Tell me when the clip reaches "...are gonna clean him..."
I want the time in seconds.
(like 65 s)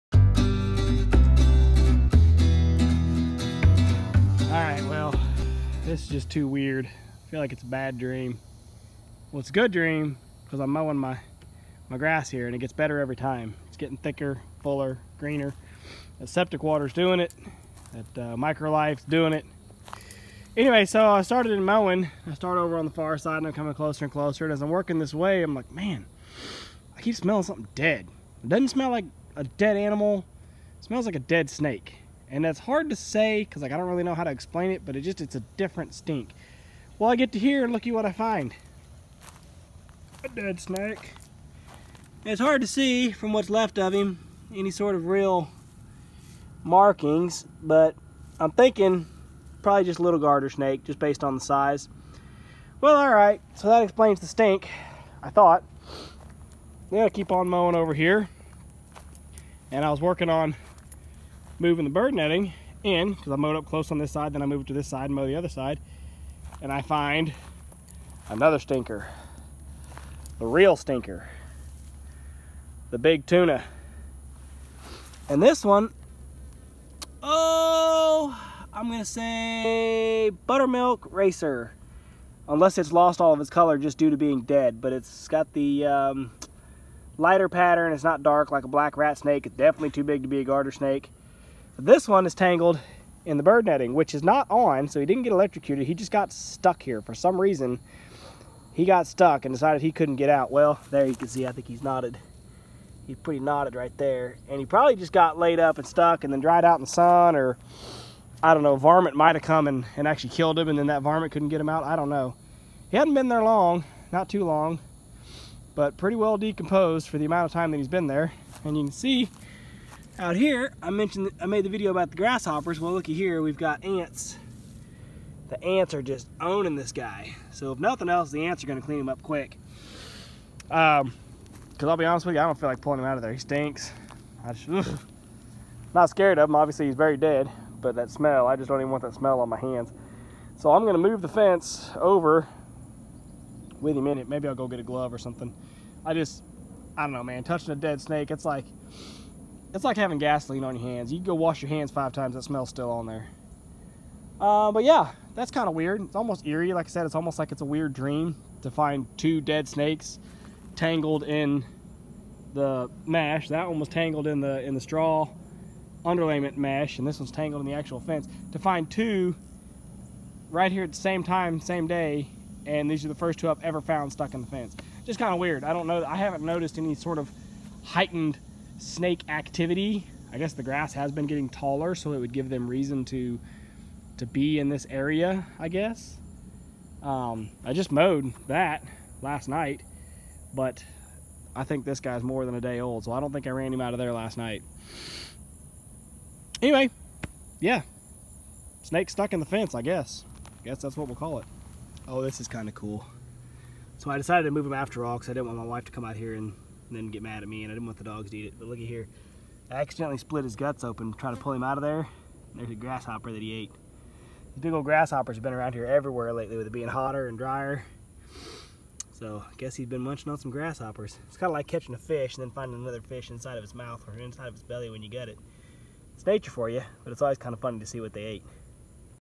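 128 s.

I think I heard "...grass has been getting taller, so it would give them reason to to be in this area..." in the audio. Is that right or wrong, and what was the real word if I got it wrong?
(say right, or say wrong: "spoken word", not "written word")
right.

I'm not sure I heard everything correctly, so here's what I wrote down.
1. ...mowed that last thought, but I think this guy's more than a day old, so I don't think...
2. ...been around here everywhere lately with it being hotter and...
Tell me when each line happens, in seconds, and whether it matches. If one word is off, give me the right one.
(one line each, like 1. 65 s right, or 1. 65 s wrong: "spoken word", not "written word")
1. 187 s wrong: "night", not "thought"
2. 215 s right.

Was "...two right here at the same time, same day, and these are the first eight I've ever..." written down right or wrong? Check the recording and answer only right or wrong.
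wrong.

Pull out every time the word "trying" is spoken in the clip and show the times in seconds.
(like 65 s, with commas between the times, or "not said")
211 s.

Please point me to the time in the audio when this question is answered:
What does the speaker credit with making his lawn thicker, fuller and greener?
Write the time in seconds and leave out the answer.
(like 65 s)
16 s.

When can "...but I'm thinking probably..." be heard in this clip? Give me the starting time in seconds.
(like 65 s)
47 s.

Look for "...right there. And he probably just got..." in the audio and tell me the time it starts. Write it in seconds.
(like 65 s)
103 s.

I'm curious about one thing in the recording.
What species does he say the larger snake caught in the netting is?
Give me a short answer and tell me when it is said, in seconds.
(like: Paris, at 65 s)
Buttermilk racer, at 80 s.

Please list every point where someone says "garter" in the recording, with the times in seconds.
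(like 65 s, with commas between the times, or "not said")
50 s, 90 s.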